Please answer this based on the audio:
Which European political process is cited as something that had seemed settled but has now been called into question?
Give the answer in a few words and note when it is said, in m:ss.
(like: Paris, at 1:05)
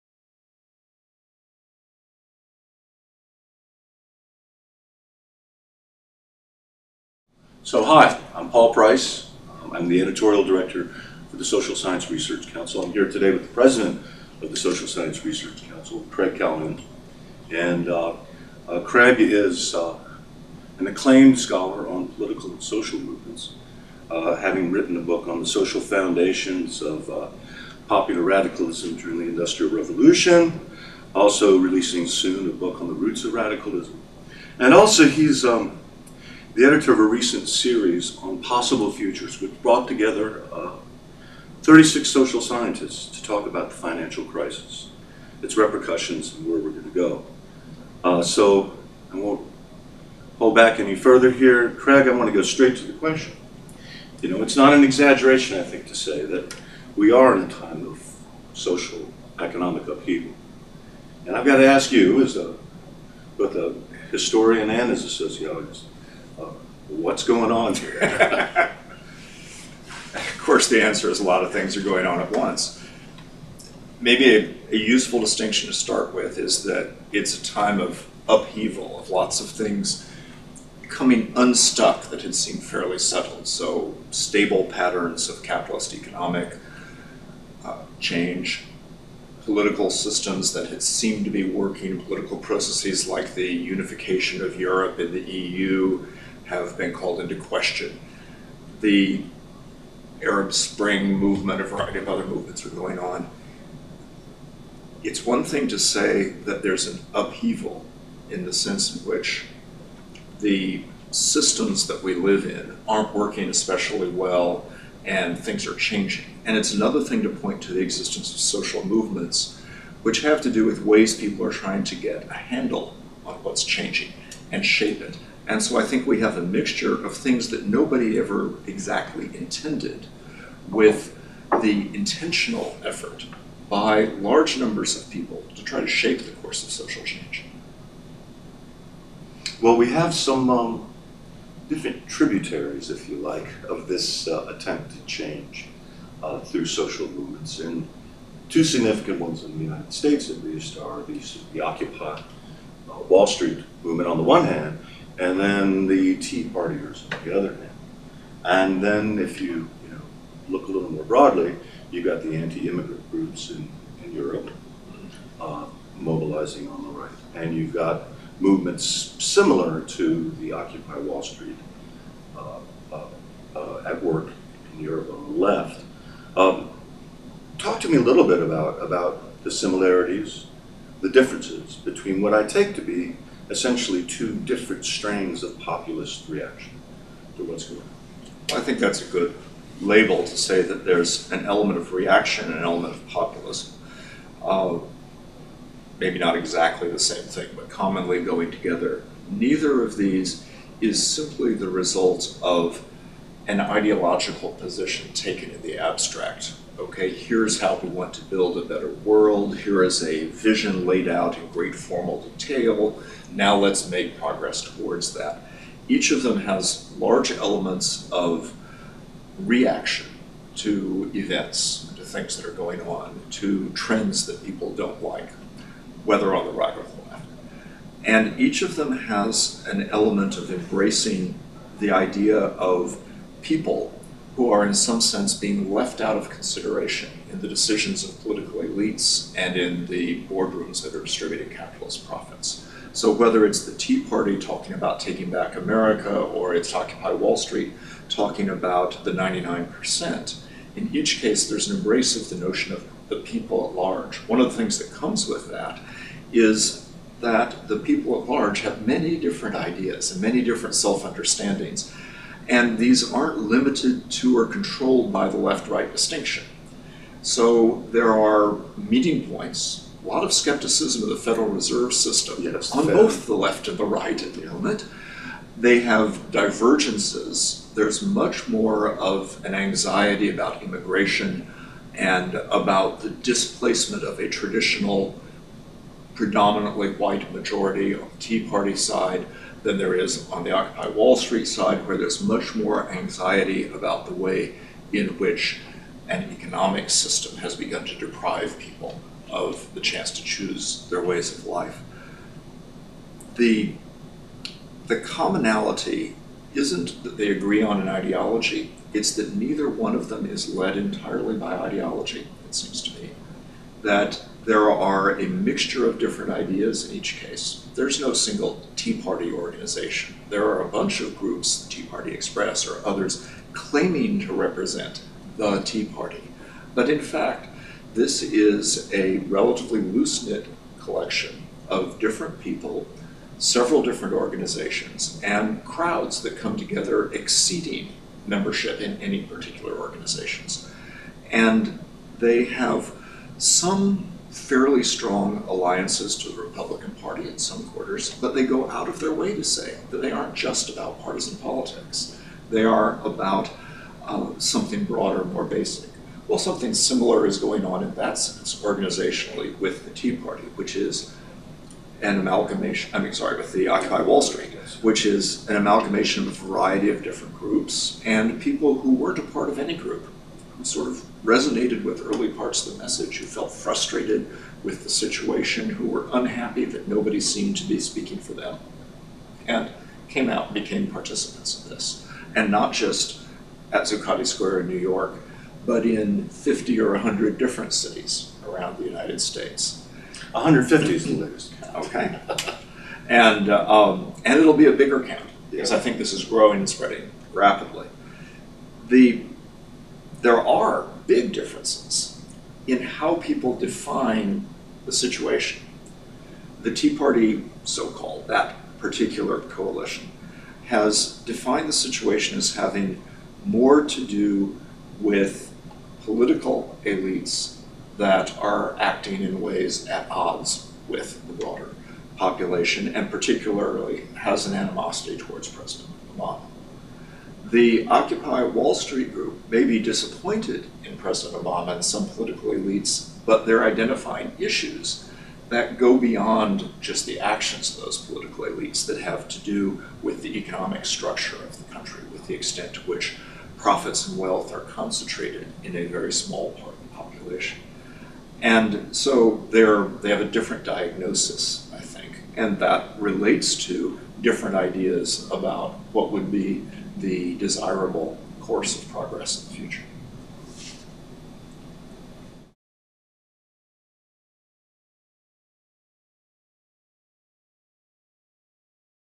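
Unification of Europe, at 1:33.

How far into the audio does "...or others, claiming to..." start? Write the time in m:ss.
5:22.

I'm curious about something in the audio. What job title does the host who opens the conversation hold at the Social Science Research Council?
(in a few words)
Editorial director.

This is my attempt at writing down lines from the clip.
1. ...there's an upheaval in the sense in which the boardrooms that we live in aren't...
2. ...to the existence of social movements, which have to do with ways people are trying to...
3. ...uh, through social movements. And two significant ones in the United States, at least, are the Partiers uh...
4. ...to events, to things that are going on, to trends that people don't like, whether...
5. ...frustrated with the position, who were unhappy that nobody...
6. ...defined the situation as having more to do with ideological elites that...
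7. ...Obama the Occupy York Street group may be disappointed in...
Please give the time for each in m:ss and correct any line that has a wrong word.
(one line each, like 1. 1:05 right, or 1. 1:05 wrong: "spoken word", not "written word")
1. 1:46 wrong: "systems", not "boardrooms"
2. 1:57 right
3. 2:26 wrong: "Occupy", not "Partiers"
4. 3:40 right
5. 6:13 wrong: "situation", not "position"
6. 6:51 wrong: "political", not "ideological"
7. 7:06 wrong: "Wall", not "York".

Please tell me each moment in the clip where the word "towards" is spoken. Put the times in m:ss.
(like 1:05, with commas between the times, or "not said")
3:34, 7:05.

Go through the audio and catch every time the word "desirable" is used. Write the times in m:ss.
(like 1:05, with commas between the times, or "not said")
7:37.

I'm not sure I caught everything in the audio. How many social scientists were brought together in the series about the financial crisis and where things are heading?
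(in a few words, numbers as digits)
36.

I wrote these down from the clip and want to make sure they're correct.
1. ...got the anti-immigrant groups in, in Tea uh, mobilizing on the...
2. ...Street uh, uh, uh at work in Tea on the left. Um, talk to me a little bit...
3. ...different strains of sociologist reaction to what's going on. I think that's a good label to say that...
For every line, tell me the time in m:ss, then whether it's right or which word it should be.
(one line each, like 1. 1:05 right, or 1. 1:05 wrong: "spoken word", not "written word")
1. 2:42 wrong: "Europe", not "Tea"
2. 2:51 wrong: "Europe", not "Tea"
3. 3:04 wrong: "populist", not "sociologist".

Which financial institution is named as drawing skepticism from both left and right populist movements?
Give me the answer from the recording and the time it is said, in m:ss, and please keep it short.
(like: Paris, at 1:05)
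Federal Reserve System, at 4:31.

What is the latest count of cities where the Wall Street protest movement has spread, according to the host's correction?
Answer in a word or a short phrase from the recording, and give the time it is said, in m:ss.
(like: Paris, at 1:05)
150, at 6:30.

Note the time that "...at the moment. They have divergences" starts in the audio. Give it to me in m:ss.
4:34.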